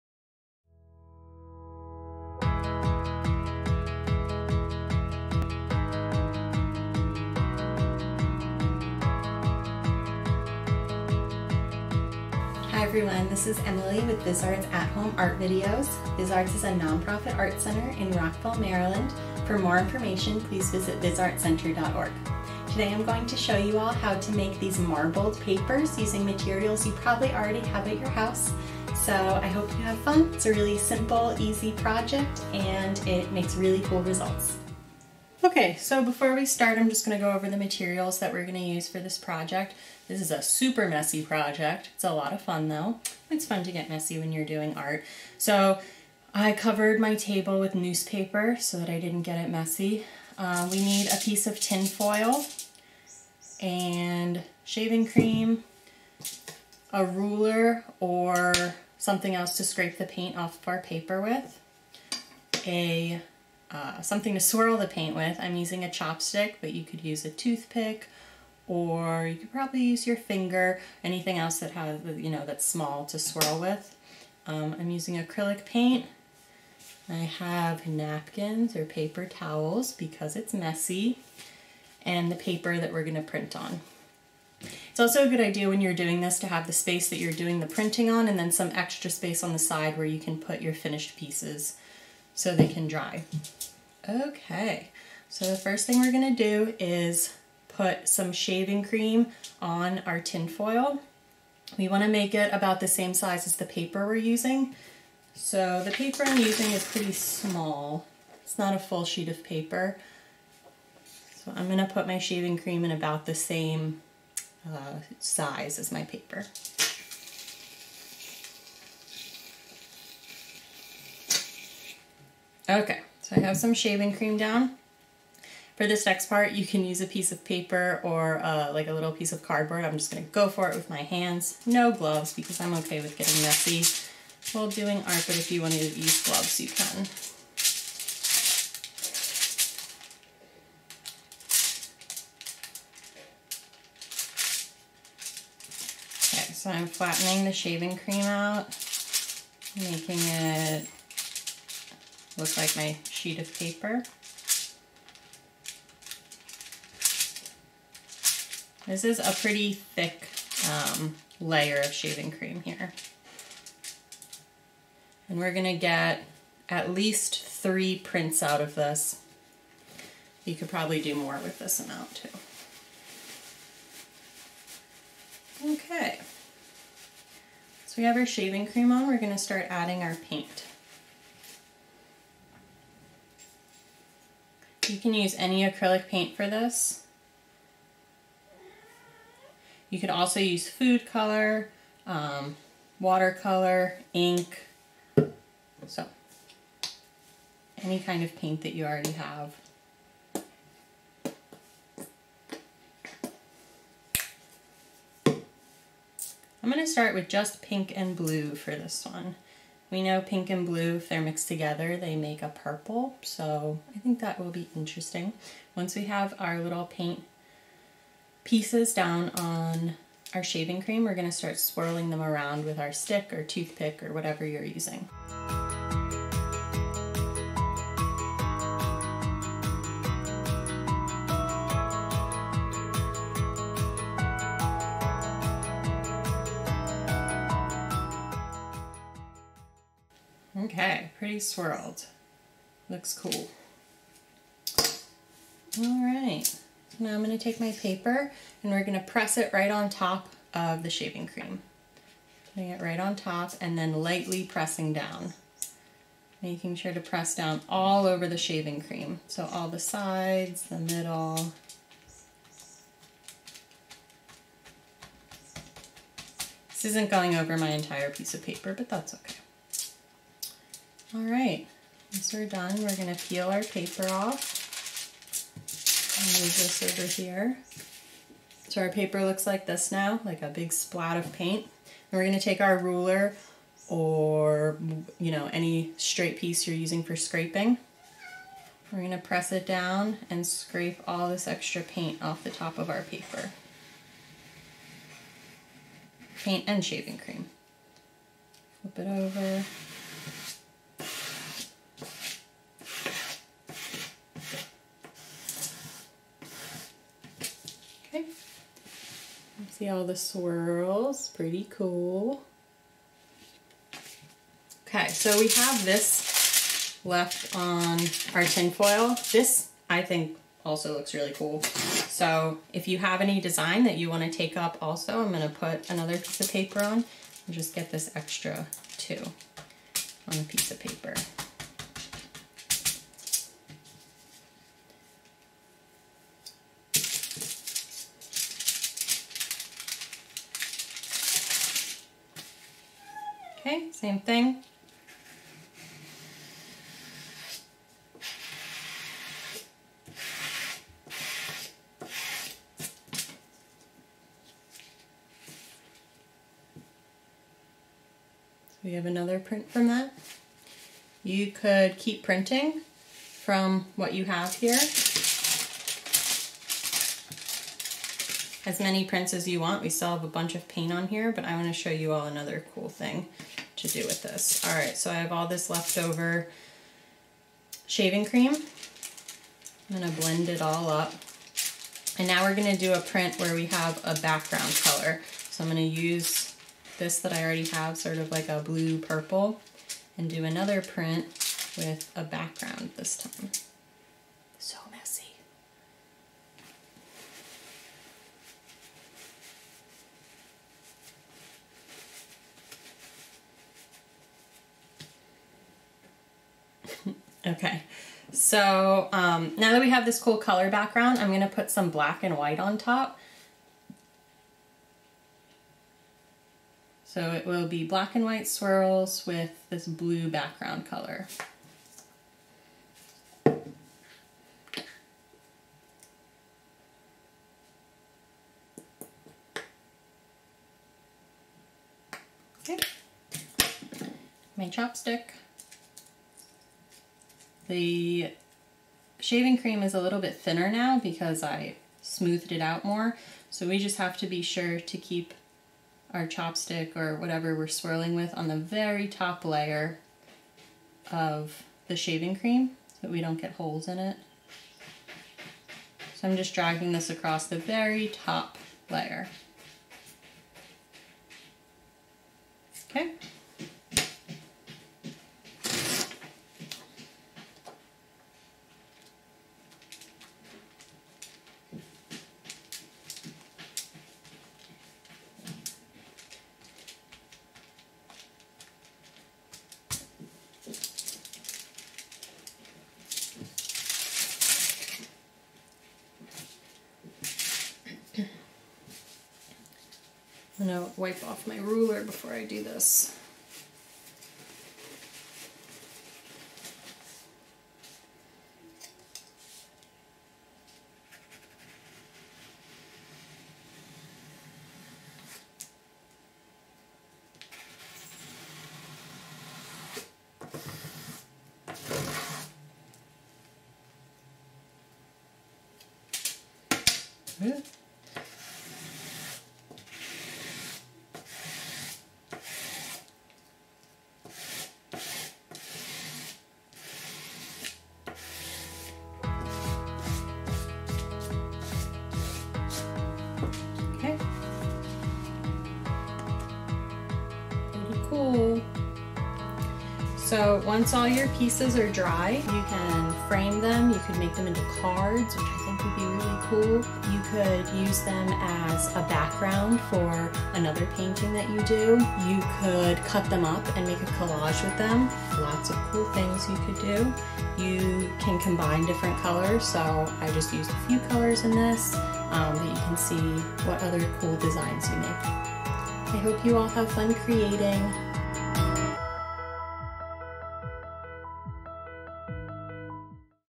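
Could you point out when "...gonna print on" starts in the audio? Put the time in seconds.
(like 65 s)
83 s.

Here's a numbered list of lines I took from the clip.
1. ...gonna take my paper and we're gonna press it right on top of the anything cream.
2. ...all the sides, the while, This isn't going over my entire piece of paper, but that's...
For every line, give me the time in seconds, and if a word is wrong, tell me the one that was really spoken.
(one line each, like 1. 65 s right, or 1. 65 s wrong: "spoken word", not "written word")
1. 247 s wrong: "shaving", not "anything"
2. 259 s wrong: "middle", not "while".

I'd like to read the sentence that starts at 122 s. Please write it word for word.
Okay, so I have some shaving cream down.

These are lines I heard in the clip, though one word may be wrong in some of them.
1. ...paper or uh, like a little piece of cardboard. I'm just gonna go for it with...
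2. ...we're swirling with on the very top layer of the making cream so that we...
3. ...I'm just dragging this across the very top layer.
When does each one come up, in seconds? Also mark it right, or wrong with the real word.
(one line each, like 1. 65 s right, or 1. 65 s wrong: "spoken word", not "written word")
1. 127 s right
2. 447 s wrong: "shaving", not "making"
3. 456 s right.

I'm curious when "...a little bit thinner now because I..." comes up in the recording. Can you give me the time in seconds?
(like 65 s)
439 s.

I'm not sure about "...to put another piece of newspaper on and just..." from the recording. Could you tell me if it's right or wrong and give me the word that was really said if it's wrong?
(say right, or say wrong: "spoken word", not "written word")
wrong: "paper", not "newspaper".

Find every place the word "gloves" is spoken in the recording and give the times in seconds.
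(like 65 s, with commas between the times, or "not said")
131 s, 136 s.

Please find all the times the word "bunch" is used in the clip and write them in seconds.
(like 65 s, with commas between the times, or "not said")
370 s.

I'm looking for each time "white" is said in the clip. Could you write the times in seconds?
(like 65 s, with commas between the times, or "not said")
412 s, 418 s.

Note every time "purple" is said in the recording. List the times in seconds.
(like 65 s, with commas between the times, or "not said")
212 s, 388 s.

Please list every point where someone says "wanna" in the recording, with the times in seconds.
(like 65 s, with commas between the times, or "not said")
101 s, 135 s.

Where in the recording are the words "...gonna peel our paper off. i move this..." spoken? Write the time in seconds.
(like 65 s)
272 s.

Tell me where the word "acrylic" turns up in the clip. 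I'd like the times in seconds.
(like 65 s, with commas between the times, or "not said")
75 s, 185 s.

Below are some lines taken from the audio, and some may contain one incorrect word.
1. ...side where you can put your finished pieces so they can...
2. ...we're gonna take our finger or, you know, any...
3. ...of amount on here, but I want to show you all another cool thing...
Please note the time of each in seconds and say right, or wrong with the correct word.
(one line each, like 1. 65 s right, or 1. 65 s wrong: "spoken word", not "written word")
1. 89 s right
2. 282 s wrong: "ruler", not "finger"
3. 370 s wrong: "paint", not "amount".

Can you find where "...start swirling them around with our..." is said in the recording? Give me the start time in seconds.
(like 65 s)
221 s.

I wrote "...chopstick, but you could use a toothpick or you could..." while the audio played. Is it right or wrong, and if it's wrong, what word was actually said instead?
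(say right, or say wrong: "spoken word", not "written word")
right.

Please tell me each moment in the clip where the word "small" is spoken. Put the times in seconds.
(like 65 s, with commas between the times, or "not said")
72 s, 107 s.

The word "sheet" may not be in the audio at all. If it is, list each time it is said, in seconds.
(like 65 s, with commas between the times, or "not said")
109 s, 153 s.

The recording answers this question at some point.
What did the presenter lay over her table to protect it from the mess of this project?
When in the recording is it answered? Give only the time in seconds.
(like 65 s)
47 s.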